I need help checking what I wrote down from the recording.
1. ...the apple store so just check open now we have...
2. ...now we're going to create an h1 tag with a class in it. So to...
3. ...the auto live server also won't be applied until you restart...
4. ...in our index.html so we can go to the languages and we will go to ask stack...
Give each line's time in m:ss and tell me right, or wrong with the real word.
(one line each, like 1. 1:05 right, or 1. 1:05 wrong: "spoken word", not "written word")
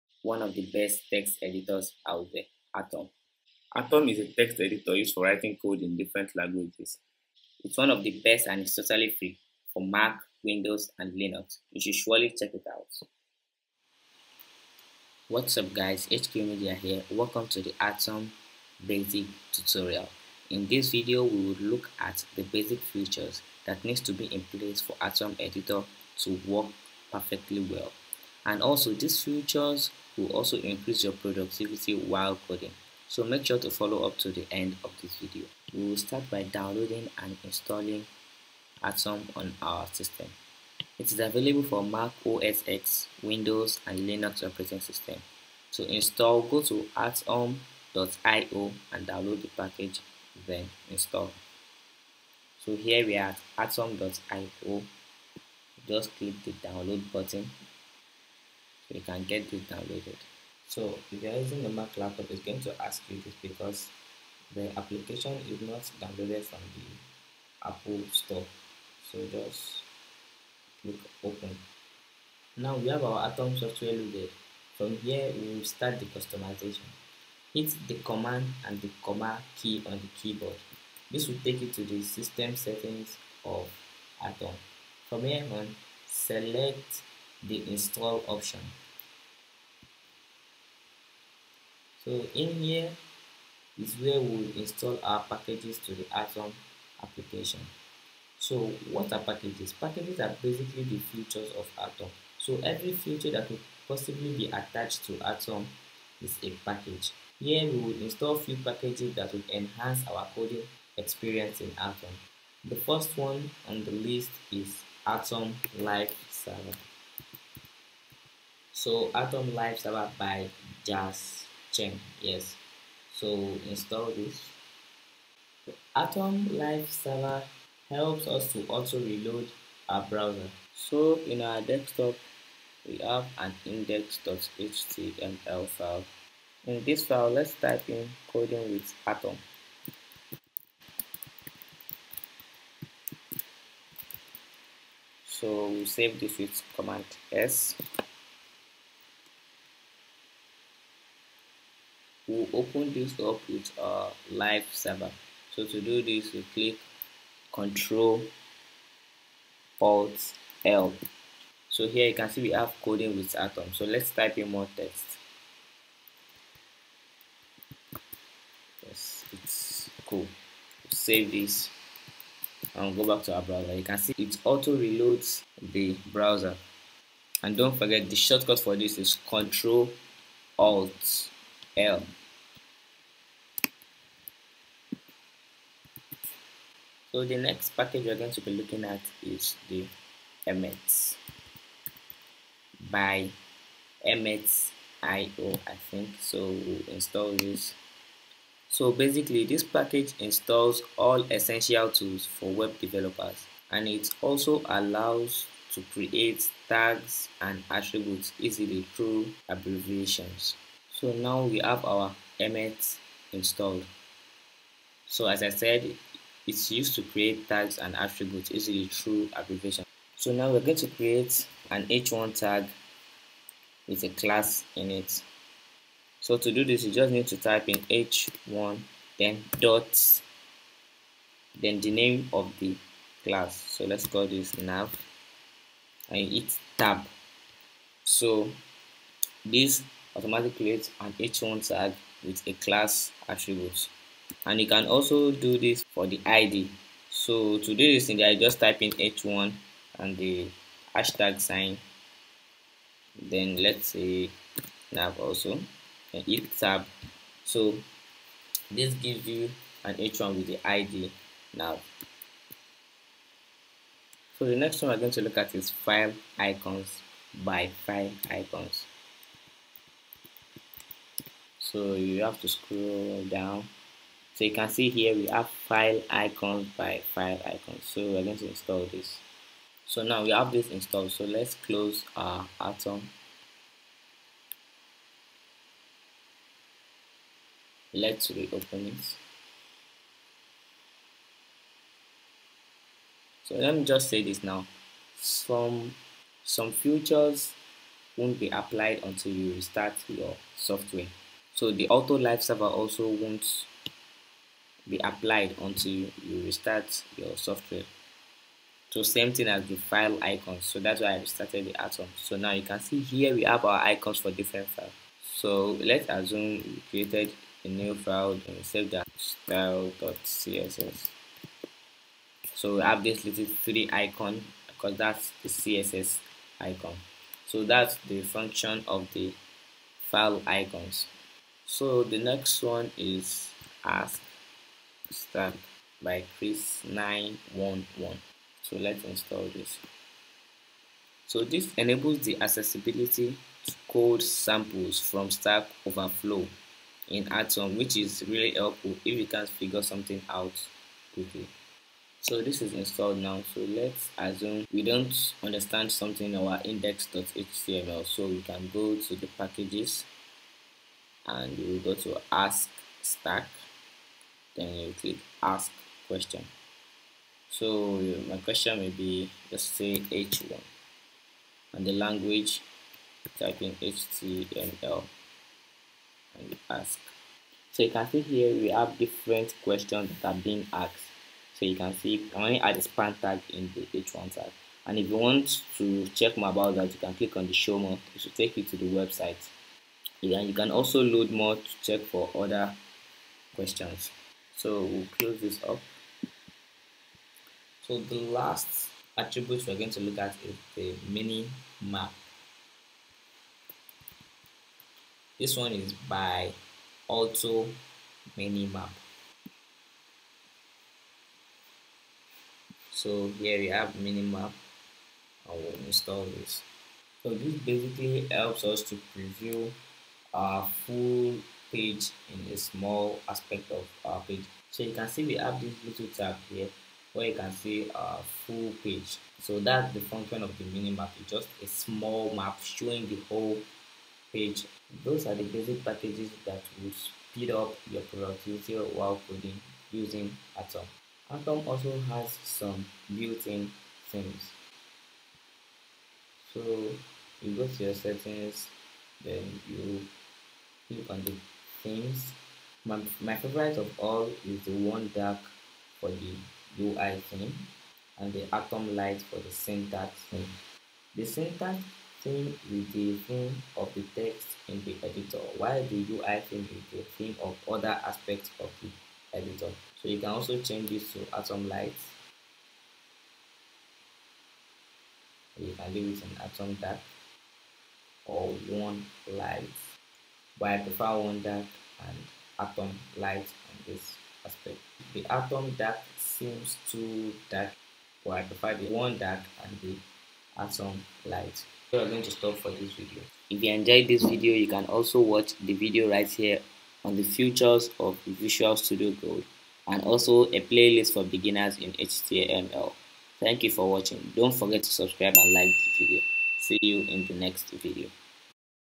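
1. 1:06 wrong: "click", not "check"
2. 3:40 right
3. 5:01 right
4. 5:56 wrong: "packages", not "languages".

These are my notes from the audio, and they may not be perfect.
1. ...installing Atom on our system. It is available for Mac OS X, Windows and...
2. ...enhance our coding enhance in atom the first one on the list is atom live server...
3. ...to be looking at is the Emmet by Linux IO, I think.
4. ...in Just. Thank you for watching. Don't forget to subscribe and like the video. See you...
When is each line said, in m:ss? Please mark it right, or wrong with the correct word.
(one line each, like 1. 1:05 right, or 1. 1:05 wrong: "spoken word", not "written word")
1. 0:37 right
2. 1:49 wrong: "experience", not "enhance"
3. 3:08 wrong: "Emmet", not "Linux"
4. 8:21 wrong: "HTML", not "Just".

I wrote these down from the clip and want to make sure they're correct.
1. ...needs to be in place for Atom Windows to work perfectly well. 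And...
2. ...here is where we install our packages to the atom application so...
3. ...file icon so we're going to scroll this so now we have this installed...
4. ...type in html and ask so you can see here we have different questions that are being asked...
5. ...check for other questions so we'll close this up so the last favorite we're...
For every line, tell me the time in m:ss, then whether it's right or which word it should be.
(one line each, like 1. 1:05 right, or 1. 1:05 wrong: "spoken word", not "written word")
1. 0:23 wrong: "Editor", not "Windows"
2. 1:32 right
3. 4:37 wrong: "install", not "scroll"
4. 6:13 right
5. 6:31 wrong: "attribute", not "favorite".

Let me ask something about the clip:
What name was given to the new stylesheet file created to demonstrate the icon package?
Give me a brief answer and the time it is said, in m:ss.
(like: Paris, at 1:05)
style.css, at 5:19.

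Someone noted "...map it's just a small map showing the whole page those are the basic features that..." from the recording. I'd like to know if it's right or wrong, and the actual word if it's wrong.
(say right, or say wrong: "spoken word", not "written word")
wrong: "packages", not "features".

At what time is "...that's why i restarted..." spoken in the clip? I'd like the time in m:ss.
5:10.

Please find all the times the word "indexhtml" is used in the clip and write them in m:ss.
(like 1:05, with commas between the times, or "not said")
2:13, 5:56.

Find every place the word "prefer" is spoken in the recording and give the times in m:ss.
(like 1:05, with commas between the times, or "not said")
8:00, 8:08.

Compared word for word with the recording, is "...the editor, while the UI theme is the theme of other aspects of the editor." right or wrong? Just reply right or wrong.
right.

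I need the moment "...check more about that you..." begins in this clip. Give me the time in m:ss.
6:26.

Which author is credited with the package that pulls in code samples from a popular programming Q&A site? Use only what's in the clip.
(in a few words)
Chris 911.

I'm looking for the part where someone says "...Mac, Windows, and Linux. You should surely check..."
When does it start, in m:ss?
0:09.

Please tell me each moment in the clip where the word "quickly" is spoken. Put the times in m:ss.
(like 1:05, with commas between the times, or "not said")
5:51.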